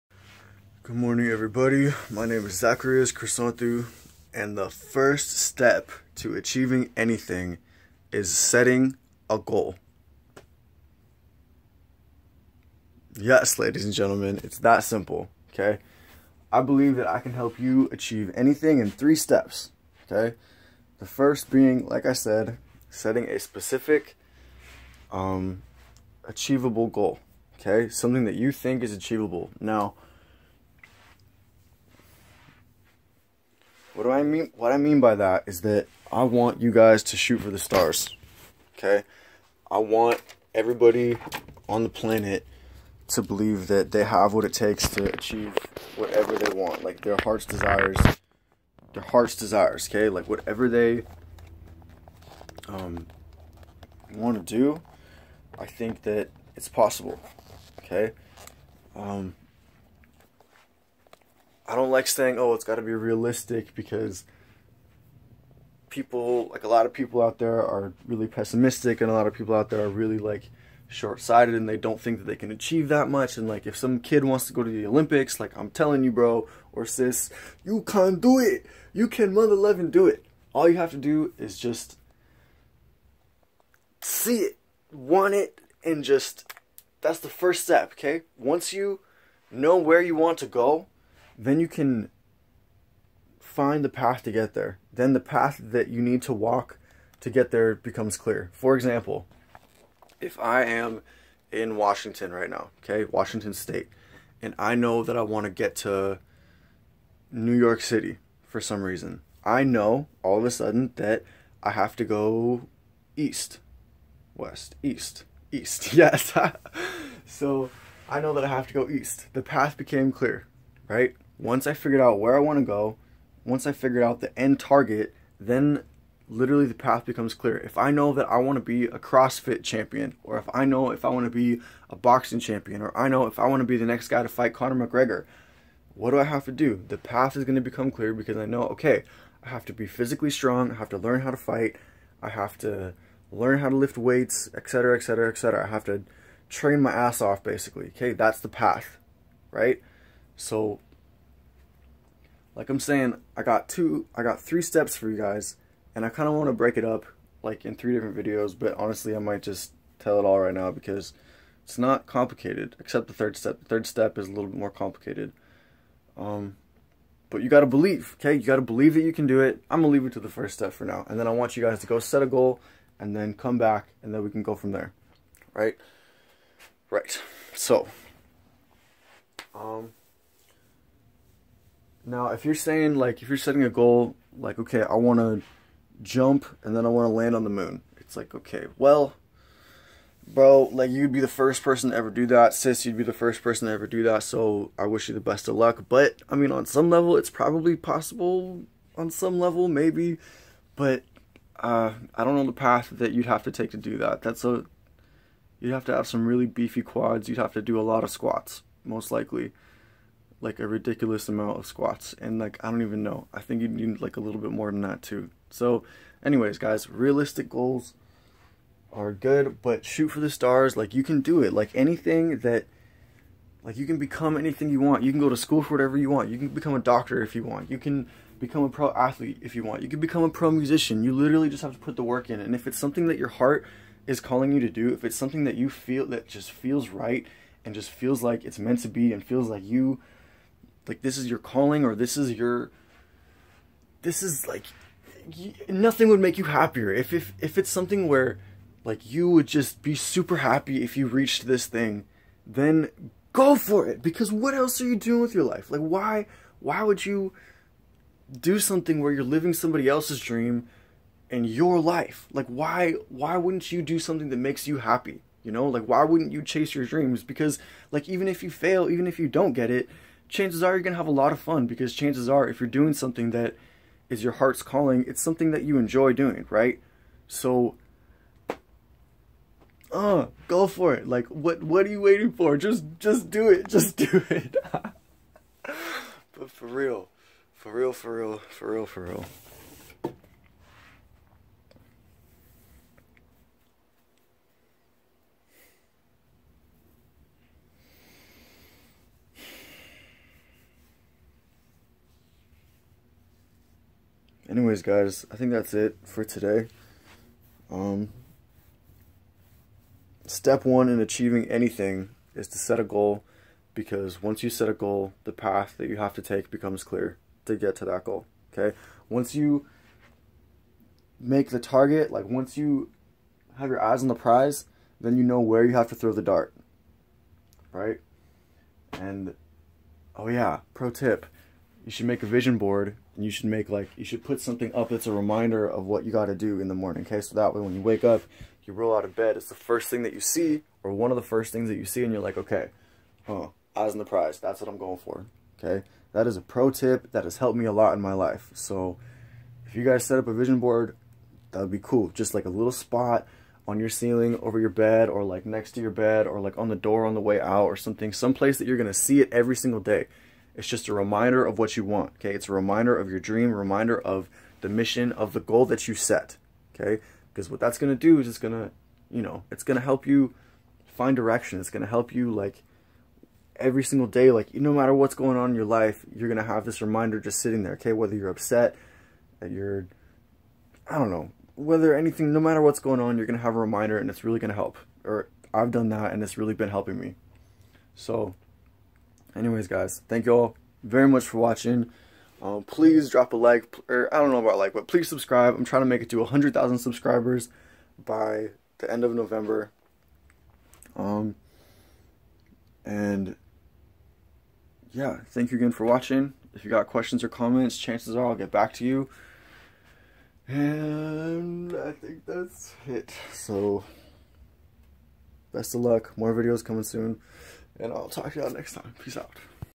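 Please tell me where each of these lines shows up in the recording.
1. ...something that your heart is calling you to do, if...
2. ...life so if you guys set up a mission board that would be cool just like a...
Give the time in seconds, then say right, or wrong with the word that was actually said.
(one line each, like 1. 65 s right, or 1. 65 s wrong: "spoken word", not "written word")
1. 232 s right
2. 348 s wrong: "vision", not "mission".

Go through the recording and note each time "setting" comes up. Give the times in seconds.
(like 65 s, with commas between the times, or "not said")
8 s, 22 s, 183 s.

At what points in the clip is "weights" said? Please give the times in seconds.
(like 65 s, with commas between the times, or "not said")
143 s.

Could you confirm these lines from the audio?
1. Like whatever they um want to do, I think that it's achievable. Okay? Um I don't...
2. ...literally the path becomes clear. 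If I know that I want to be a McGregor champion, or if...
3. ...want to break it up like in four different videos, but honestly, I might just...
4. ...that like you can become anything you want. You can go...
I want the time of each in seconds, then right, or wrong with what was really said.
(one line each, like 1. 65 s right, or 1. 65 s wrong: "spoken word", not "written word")
1. 50 s wrong: "possible", not "achievable"
2. 126 s wrong: "CrossFit", not "McGregor"
3. 156 s wrong: "three", not "four"
4. 222 s right.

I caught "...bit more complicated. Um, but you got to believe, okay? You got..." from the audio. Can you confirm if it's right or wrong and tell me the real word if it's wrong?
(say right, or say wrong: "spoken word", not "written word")
right.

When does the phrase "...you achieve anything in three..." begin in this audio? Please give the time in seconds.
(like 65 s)
17 s.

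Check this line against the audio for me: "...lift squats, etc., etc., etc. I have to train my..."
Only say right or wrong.
wrong.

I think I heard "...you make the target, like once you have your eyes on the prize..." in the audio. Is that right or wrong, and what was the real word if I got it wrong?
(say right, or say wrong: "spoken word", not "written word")
right.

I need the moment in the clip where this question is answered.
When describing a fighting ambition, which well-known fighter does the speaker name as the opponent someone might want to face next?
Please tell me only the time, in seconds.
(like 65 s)
134 s.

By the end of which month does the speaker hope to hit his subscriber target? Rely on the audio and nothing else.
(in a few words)
November.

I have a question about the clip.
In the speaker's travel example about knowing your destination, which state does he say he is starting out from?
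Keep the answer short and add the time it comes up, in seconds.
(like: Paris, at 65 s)
Washington State, at 103 s.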